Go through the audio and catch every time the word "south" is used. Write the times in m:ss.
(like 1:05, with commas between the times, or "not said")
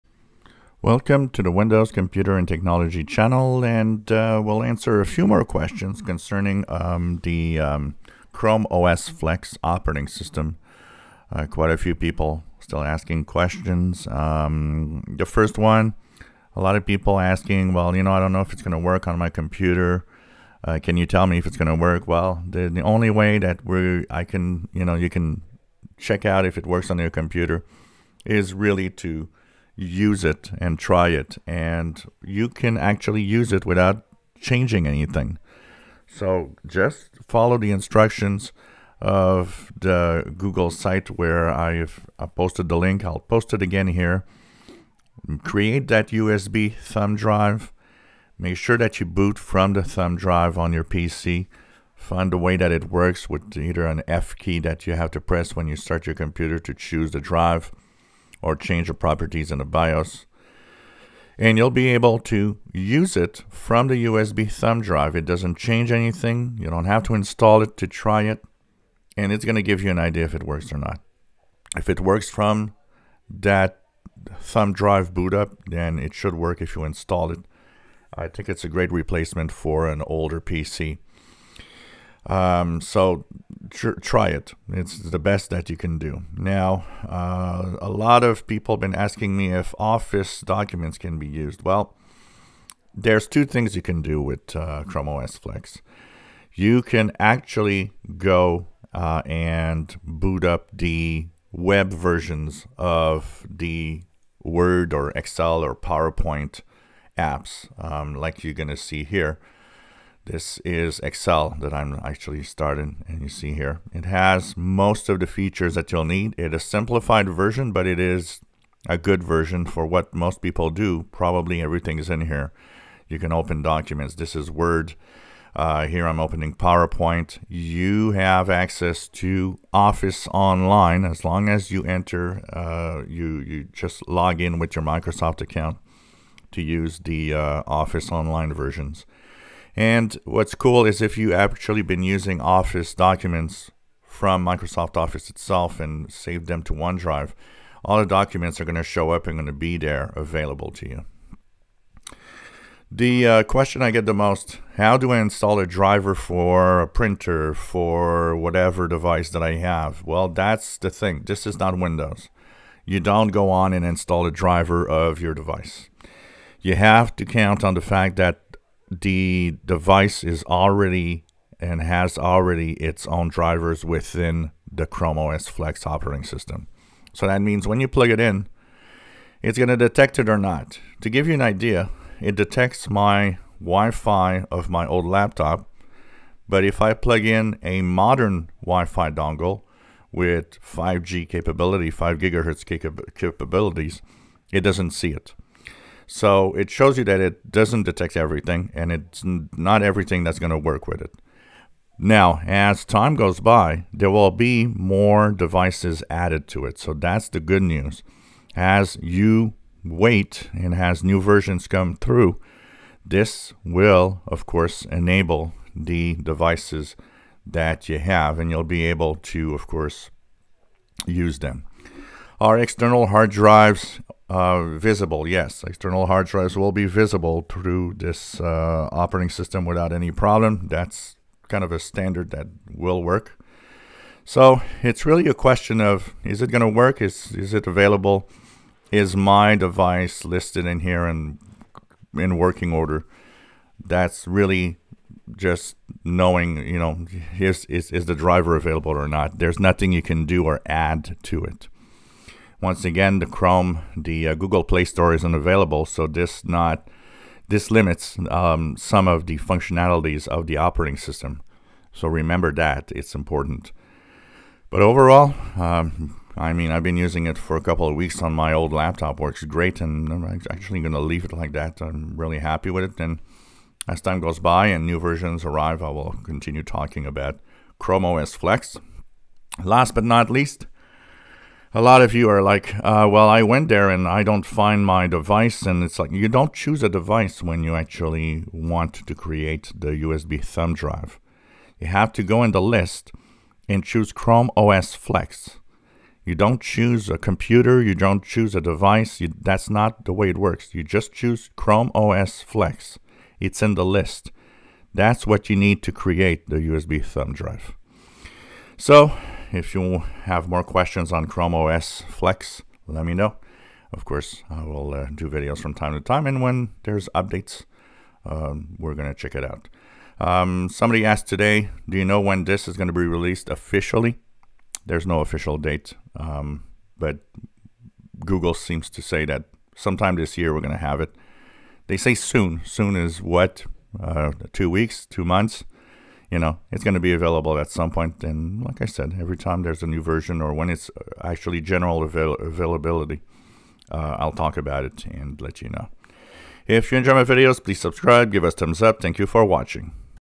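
not said.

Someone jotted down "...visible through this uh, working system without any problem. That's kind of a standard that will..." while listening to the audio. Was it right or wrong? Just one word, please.
wrong.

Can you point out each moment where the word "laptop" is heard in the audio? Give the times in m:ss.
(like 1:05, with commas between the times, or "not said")
3:05, 4:28.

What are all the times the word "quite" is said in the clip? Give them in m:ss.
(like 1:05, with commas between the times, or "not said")
0:11.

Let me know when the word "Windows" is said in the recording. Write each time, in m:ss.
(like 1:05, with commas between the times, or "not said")
0:01, 2:41.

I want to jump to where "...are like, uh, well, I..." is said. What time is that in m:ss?
4:42.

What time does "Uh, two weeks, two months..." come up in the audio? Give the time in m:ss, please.
5:34.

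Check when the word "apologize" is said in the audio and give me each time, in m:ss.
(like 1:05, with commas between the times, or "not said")
not said.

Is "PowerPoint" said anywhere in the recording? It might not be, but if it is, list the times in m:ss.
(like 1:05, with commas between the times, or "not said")
1:45, 2:06.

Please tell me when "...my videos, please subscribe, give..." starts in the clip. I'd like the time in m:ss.
5:47.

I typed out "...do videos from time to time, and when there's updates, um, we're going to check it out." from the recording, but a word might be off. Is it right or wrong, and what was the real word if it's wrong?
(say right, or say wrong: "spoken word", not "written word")
right.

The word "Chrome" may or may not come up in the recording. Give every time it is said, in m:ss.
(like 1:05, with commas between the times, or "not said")
0:08, 1:34, 2:54, 4:13, 4:37, 4:54, 5:01, 5:11.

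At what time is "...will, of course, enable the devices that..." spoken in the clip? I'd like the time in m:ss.
3:33.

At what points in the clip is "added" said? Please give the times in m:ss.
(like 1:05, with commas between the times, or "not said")
3:26.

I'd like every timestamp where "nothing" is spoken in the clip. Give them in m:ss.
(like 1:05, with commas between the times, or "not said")
4:09.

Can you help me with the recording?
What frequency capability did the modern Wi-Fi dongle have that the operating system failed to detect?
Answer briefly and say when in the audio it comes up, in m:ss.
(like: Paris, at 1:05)
5 gigahertz, at 3:11.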